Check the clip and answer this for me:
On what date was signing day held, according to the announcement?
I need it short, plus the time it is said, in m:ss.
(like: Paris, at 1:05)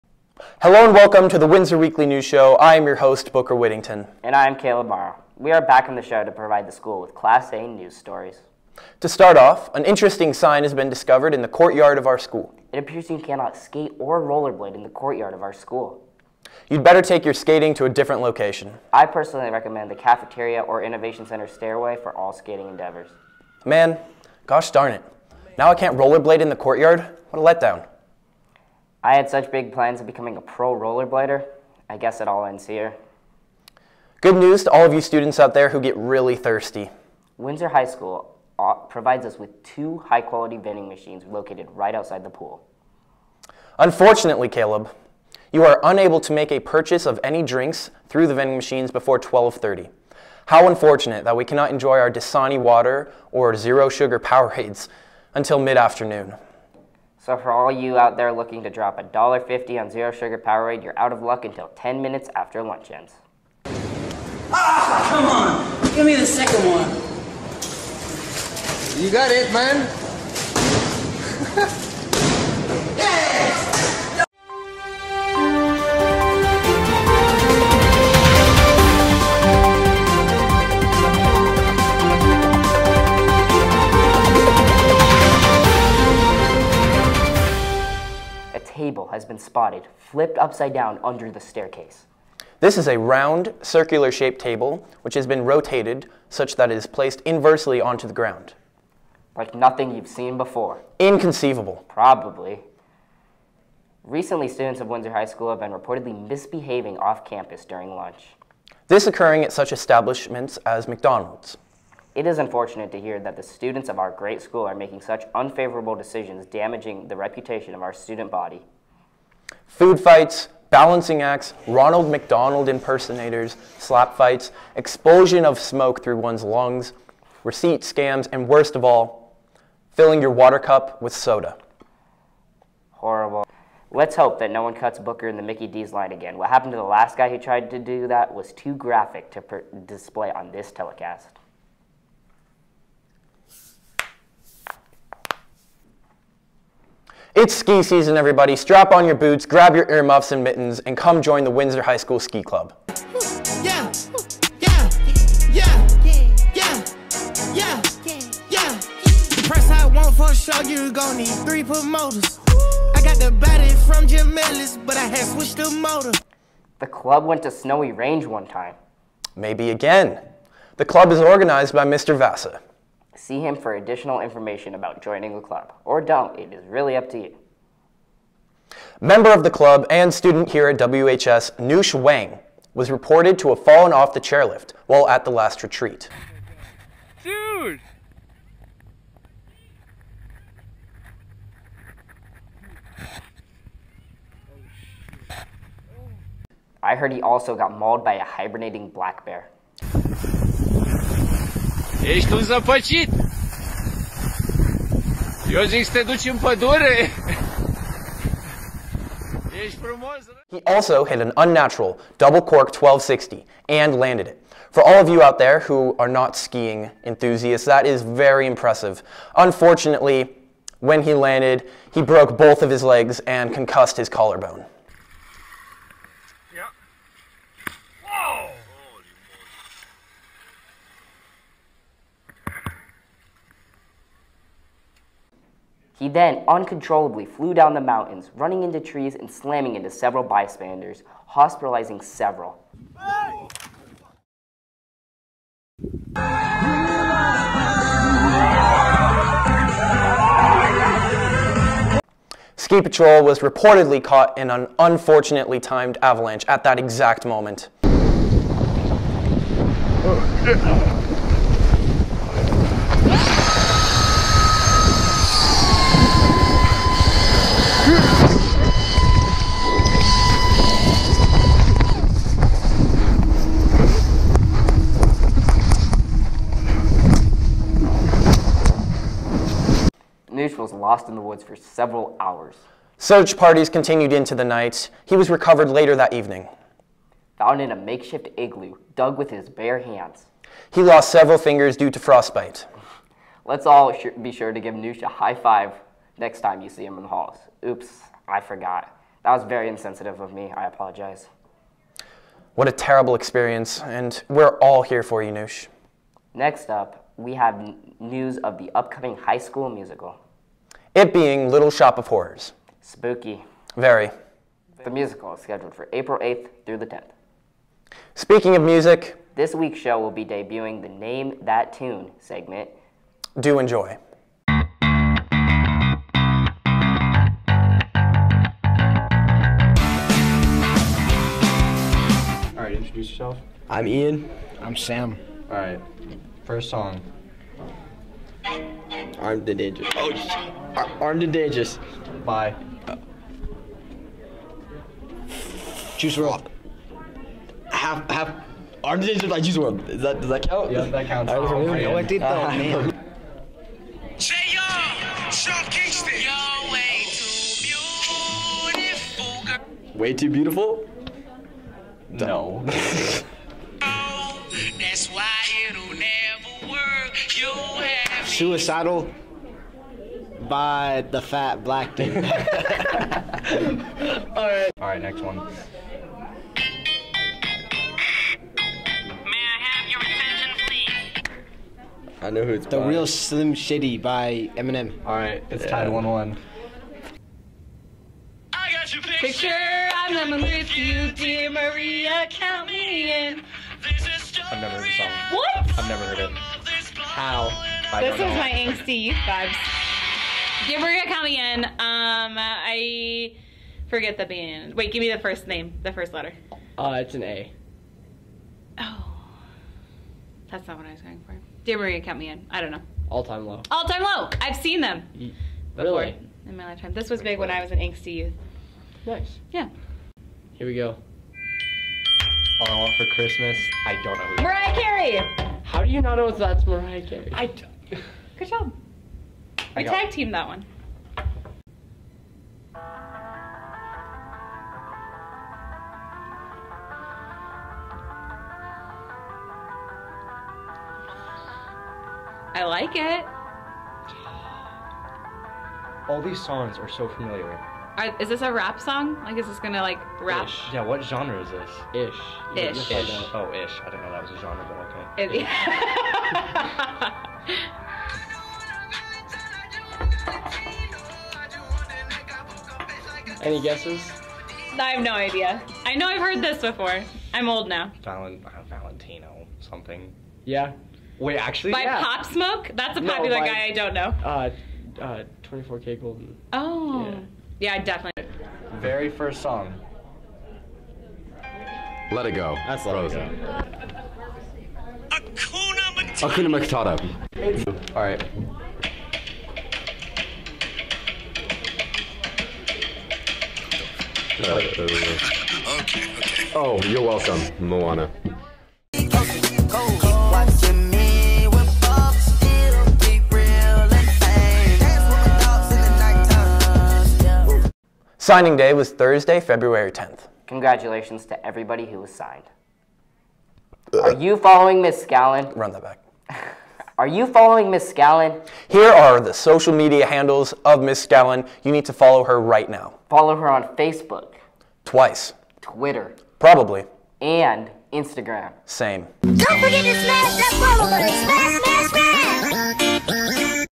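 Thursday, February 10th, at 8:28.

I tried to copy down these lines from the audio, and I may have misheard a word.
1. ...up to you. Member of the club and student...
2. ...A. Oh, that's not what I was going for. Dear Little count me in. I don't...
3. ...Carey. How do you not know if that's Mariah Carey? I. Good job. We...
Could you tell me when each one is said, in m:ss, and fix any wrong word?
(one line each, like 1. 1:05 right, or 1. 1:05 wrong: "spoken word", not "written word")
1. 2:56 right
2. 6:47 wrong: "Maria", not "Little"
3. 7:04 right.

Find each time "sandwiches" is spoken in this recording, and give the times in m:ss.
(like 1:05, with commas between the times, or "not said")
not said.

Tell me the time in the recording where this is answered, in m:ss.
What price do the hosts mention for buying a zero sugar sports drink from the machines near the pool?
0:58.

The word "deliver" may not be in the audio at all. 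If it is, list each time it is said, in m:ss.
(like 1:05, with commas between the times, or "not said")
not said.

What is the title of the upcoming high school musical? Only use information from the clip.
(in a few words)
Little Shop of Horrors.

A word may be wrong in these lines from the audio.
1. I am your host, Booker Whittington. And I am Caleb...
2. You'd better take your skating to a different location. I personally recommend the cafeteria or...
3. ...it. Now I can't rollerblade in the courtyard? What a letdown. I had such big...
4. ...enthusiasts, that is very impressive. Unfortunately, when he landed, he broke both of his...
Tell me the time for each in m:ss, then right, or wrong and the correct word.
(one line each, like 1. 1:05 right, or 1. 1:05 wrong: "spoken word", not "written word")
1. 0:02 right
2. 0:16 right
3. 0:24 right
4. 3:37 right.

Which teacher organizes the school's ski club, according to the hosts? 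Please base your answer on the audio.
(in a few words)
Mr. Vassa.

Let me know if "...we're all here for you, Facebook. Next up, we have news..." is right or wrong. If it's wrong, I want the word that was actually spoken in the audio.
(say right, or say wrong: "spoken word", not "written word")
wrong: "Noosh", not "Facebook".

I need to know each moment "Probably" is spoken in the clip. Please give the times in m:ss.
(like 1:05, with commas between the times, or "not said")
1:41, 8:46.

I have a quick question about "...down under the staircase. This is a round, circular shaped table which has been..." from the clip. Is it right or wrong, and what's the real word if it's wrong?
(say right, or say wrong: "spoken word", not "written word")
right.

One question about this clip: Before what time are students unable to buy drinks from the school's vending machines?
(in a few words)
12:30.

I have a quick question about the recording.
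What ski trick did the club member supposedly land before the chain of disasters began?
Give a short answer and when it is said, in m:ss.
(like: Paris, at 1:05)
double cork 1260, at 3:32.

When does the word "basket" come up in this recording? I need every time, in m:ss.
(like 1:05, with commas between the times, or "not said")
not said.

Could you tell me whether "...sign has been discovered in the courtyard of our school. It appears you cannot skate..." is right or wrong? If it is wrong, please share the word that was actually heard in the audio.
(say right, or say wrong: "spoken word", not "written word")
right.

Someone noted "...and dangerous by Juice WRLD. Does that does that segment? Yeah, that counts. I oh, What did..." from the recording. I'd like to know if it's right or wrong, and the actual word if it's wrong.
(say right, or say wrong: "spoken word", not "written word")
wrong: "count", not "segment".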